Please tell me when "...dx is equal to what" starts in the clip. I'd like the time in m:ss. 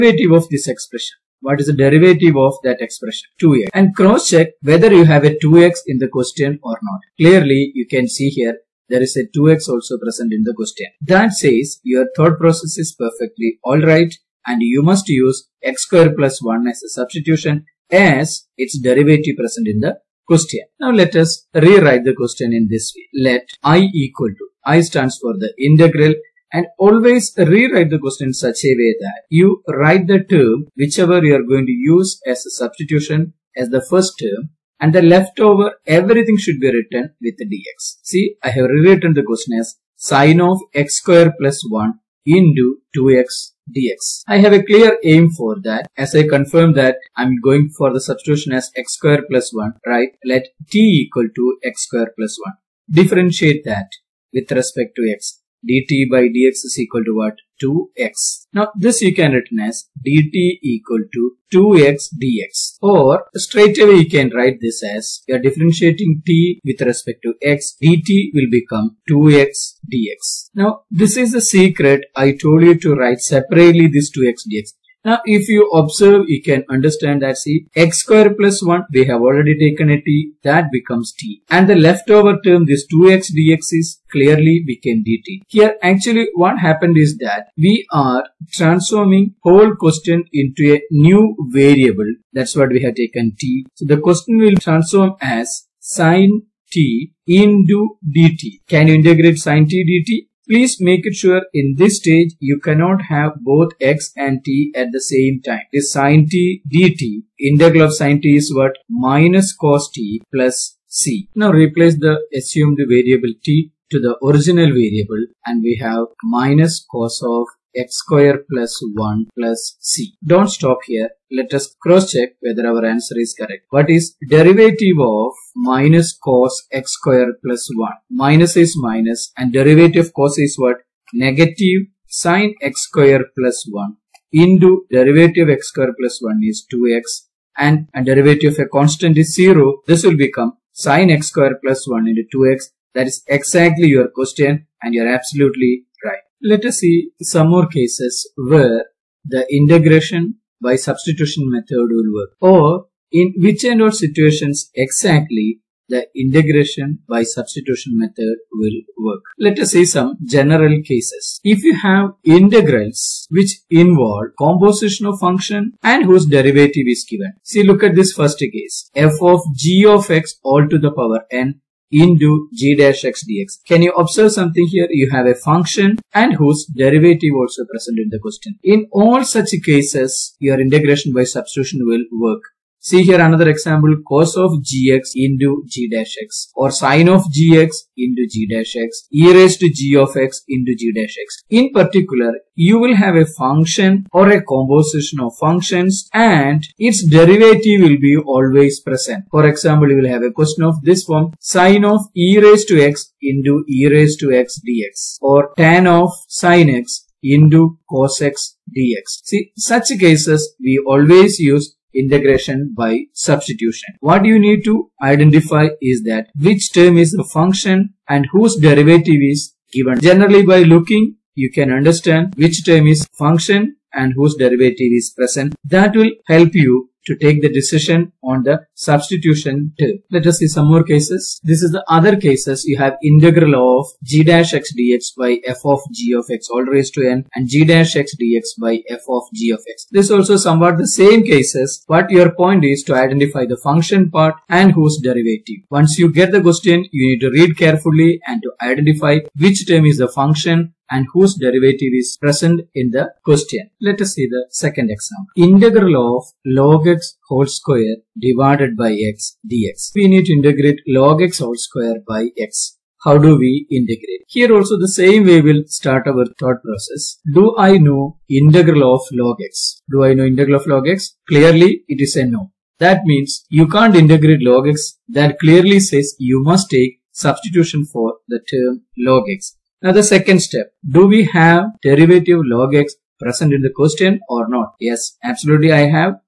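0:56.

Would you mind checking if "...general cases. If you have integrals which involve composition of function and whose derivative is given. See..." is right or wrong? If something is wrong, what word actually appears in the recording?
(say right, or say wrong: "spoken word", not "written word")
right.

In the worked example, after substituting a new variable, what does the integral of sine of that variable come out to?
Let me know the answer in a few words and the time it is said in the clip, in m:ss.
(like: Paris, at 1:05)
Minus cos t plus c, at 1:48.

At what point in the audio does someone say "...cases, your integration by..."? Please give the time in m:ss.
2:59.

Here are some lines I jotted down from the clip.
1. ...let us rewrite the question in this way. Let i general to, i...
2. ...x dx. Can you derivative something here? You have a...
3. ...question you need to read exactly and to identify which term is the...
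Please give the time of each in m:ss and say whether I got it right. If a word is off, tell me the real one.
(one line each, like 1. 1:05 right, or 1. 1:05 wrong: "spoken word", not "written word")
1. 0:20 wrong: "equal", not "general"
2. 2:53 wrong: "observe", not "derivative"
3. 4:06 wrong: "carefully", not "exactly".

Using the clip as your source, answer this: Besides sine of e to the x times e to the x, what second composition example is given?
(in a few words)
tan of sine x.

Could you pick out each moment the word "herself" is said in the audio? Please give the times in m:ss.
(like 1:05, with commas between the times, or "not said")
not said.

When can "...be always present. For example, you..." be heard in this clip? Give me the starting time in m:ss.
3:18.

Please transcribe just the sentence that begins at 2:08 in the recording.
Minus is minus and derivative cos is what?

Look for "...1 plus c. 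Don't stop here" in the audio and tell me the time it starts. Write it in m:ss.
1:58.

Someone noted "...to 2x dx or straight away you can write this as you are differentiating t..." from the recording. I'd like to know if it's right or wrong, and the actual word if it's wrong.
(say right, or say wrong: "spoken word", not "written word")
right.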